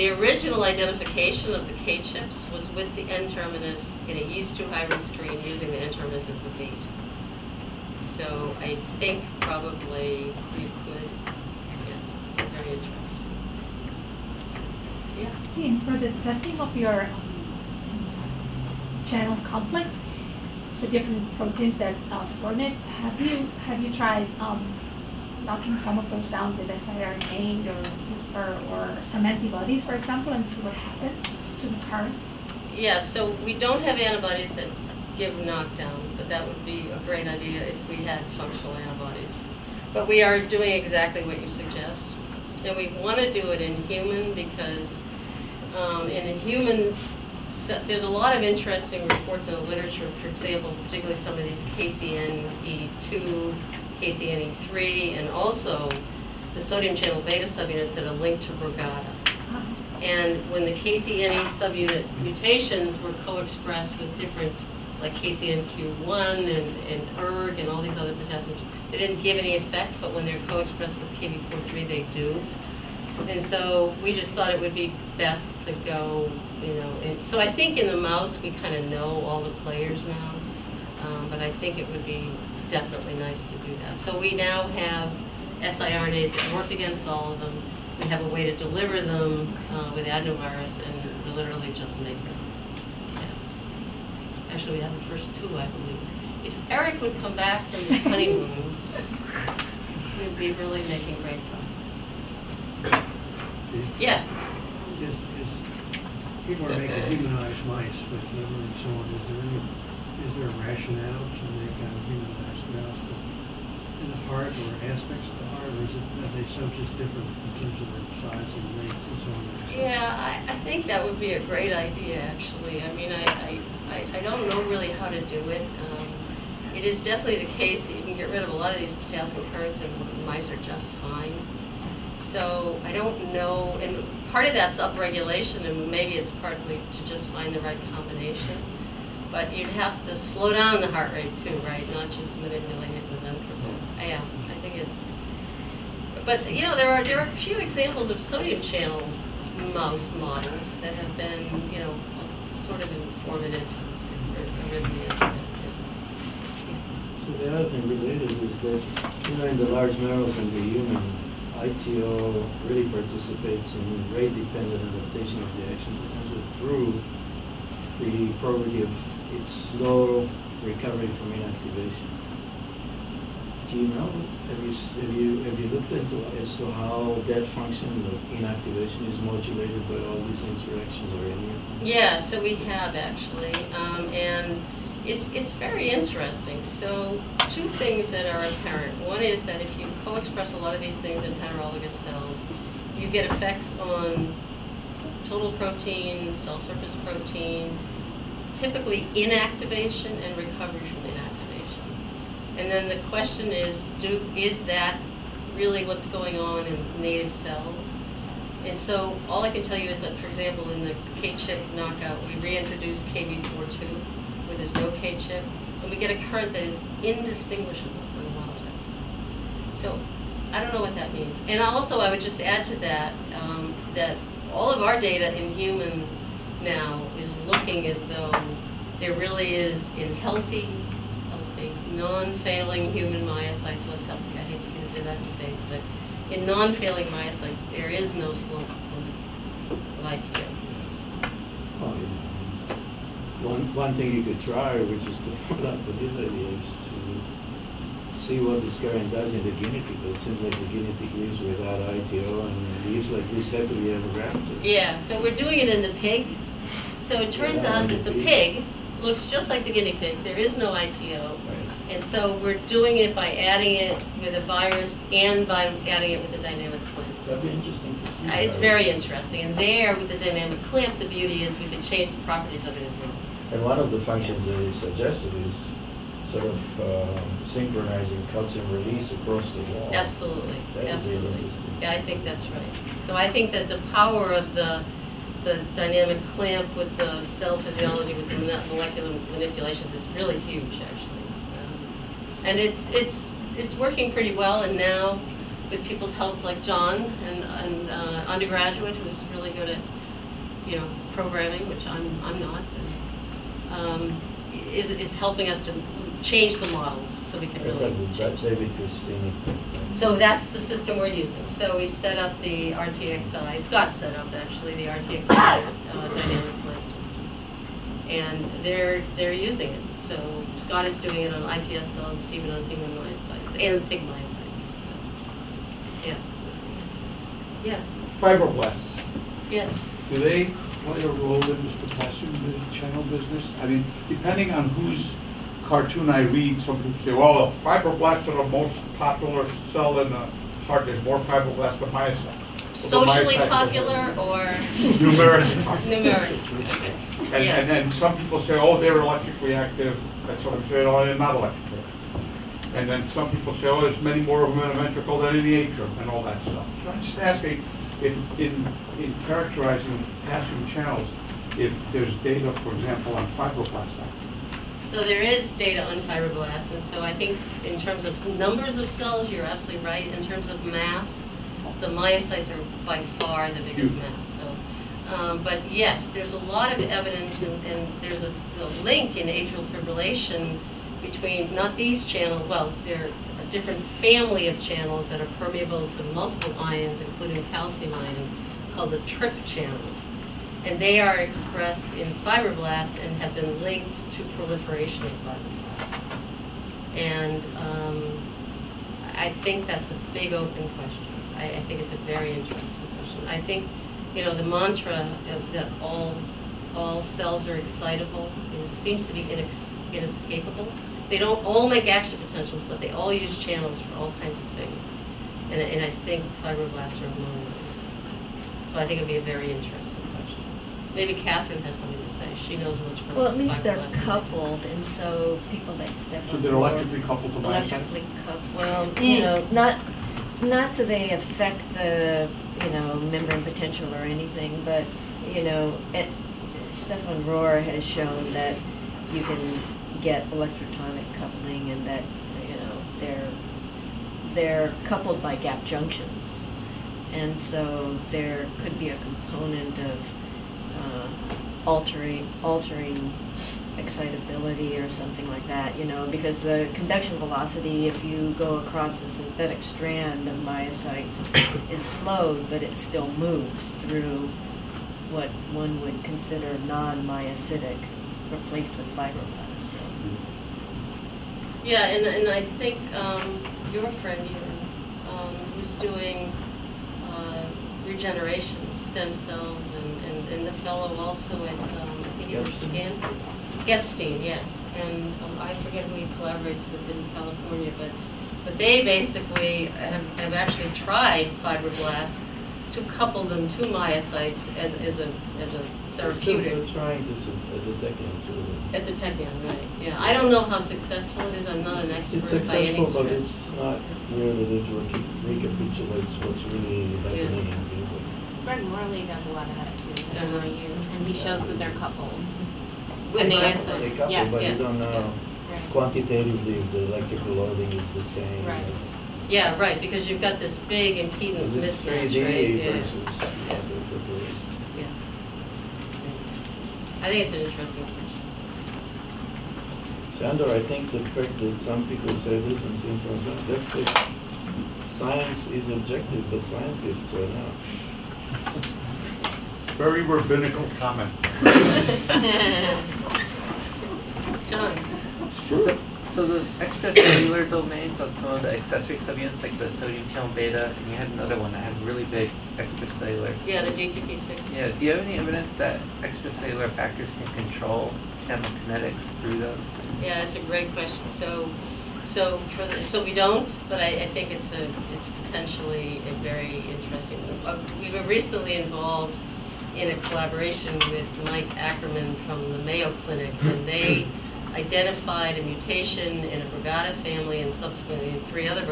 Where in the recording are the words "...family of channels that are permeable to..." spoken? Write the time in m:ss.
6:24.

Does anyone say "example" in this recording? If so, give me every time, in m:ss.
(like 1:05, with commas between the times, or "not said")
0:29, 0:50, 2:27, 3:30, 6:02.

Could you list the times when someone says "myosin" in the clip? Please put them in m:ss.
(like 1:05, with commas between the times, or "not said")
7:07.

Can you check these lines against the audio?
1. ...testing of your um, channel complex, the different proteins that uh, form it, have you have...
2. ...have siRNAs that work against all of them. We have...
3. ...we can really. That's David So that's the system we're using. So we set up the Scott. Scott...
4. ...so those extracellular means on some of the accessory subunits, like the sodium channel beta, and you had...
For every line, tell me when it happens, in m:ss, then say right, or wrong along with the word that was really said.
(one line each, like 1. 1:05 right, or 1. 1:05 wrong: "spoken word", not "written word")
1. 0:16 right
2. 1:24 right
3. 5:07 wrong: "RTXI", not "Scott"
4. 9:06 wrong: "domains", not "means".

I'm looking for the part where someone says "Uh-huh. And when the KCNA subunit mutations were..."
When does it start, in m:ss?
0:58.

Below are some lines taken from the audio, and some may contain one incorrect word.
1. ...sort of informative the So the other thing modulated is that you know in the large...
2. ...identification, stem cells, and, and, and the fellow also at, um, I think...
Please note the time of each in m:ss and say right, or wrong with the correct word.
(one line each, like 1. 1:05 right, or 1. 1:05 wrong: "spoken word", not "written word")
1. 2:32 wrong: "related", not "modulated"
2. 7:57 wrong: "regeneration", not "identification".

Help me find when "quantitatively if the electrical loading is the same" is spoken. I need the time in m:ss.
8:35.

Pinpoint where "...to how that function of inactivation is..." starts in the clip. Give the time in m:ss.
2:56.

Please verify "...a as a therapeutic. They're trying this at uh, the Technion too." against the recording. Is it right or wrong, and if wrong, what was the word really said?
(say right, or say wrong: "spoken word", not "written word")
right.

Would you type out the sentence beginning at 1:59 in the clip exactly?
Yeah, I, I think that would be a great idea, actually.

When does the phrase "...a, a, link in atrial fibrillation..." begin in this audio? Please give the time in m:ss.
6:18.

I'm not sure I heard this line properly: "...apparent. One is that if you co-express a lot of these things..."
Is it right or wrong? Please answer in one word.
right.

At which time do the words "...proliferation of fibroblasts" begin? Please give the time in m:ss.
6:34.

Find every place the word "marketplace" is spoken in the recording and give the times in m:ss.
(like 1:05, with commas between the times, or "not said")
not said.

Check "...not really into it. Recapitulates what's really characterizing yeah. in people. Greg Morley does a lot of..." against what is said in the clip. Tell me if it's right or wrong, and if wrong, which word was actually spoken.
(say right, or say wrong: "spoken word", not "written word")
wrong: "happening", not "characterizing".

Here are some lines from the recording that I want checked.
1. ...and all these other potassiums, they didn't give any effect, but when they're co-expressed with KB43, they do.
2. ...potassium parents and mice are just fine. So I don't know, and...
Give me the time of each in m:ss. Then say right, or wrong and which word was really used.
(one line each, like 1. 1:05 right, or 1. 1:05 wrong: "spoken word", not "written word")
1. 1:07 right
2. 2:09 wrong: "currents", not "parents".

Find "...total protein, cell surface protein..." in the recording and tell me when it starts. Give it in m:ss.
3:15.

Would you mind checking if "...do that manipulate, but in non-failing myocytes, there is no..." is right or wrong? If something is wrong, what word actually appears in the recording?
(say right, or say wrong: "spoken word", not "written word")
wrong: "debate", not "manipulate".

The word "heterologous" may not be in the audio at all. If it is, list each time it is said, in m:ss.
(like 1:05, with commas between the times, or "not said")
3:11.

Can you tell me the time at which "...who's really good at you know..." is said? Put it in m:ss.
4:58.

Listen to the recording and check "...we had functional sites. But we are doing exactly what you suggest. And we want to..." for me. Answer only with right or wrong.
wrong.